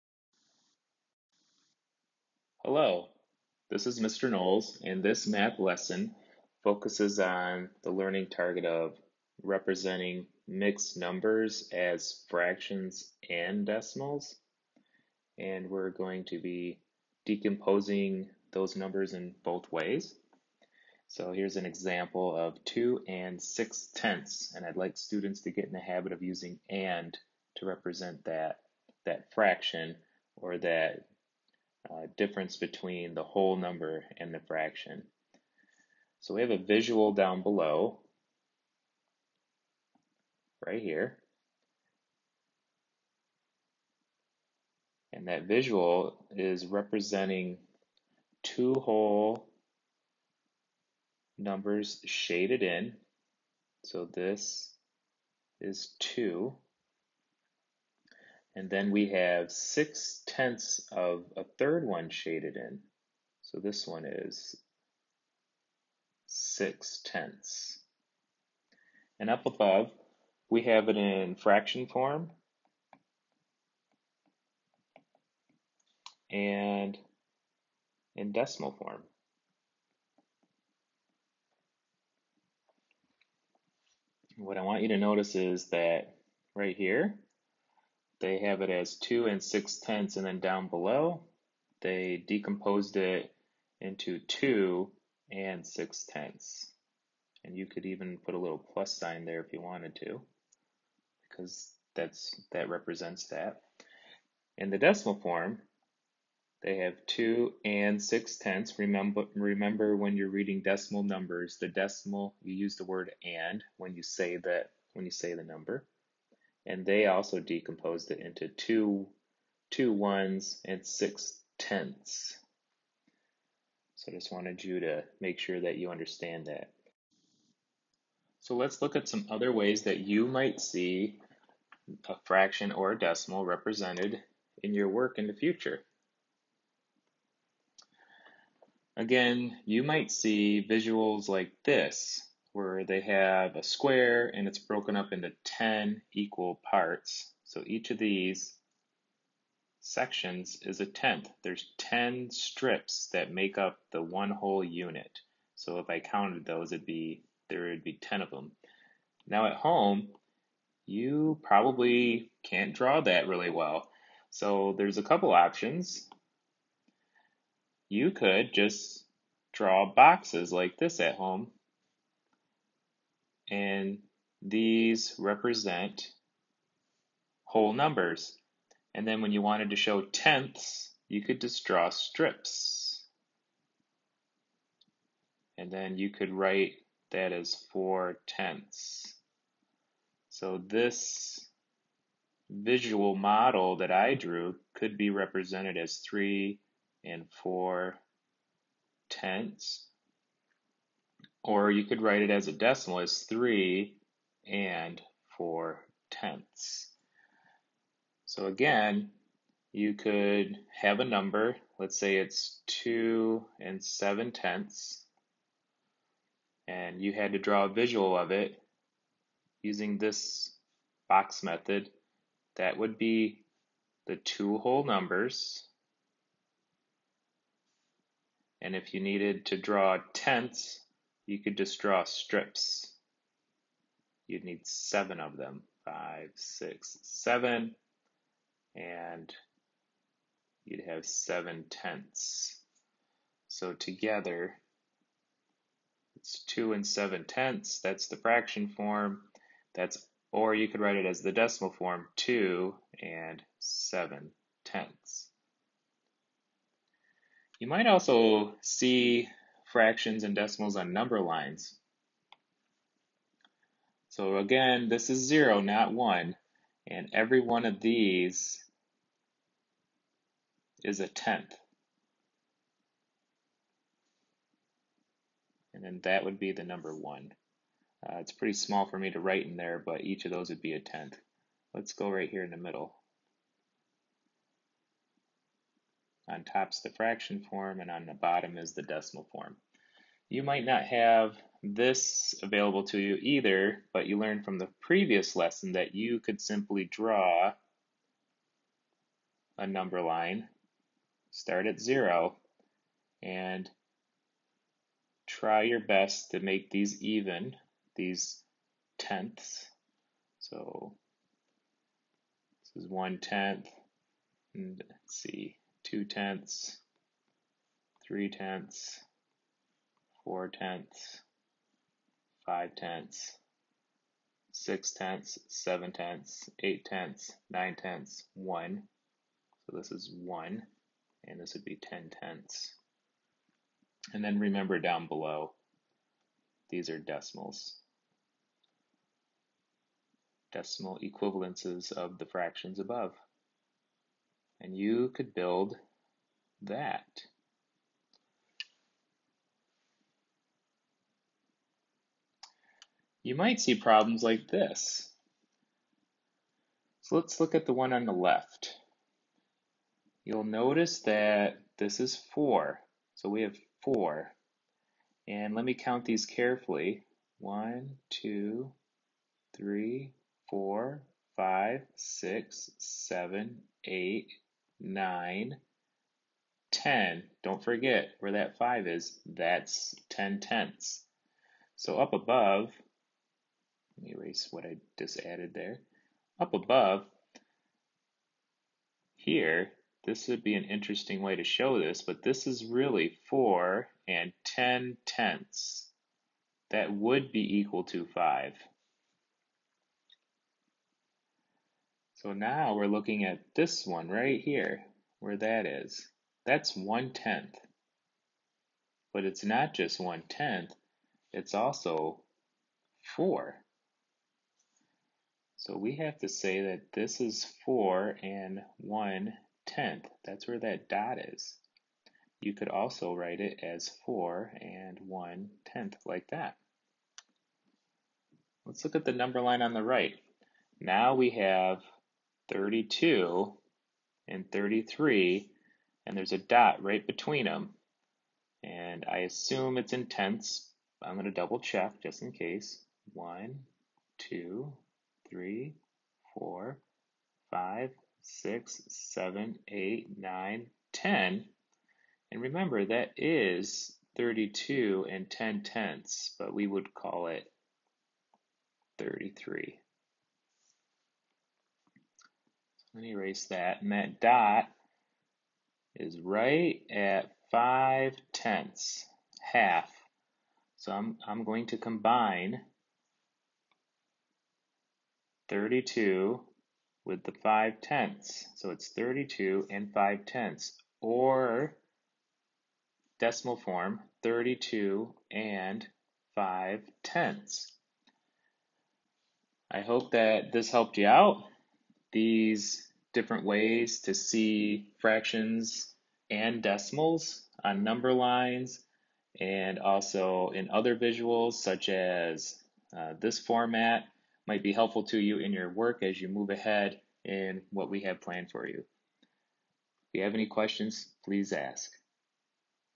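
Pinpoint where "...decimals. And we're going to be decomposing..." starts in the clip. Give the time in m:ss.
0:13.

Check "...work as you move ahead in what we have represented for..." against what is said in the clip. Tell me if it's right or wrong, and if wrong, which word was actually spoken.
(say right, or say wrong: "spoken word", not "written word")
wrong: "planned", not "represented".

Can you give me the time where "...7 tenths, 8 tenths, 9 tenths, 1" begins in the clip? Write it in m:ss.
5:25.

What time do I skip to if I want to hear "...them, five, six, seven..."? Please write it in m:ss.
3:55.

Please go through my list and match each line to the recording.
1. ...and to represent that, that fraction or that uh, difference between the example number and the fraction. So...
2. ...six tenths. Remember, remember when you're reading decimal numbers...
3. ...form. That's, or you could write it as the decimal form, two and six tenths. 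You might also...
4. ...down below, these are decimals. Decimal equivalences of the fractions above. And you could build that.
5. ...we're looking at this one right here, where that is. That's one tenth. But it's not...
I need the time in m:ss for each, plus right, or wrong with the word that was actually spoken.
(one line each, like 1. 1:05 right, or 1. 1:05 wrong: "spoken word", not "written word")
1. 0:26 wrong: "whole", not "example"
2. 1:48 right
3. 4:08 wrong: "seven", not "six"
4. 5:34 right
5. 6:42 right.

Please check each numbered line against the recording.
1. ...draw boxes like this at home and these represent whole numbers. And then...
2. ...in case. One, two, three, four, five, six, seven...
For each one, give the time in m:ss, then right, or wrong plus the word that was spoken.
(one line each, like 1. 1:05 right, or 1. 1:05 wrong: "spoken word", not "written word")
1. 2:49 right
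2. 7:22 right.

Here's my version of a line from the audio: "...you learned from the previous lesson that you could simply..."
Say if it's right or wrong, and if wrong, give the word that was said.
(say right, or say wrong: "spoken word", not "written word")
right.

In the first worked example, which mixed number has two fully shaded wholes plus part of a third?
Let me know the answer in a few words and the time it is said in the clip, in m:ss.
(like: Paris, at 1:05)
2 and 6 tenths, at 0:22.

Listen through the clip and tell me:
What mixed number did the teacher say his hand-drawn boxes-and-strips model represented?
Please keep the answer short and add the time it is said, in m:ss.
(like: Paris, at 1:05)
3 and 4 tenths, at 3:15.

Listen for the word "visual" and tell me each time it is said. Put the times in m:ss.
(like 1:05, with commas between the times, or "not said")
0:36, 0:45, 2:20, 3:12, 3:37, 8:20.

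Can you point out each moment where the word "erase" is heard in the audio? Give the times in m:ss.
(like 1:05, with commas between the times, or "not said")
6:24, 7:43.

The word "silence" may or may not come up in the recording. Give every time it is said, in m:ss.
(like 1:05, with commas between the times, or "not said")
not said.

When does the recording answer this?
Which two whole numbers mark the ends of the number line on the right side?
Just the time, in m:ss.
7:12.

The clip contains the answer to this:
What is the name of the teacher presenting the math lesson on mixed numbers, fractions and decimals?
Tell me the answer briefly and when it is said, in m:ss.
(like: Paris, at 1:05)
Mr. Knowles, at 0:03.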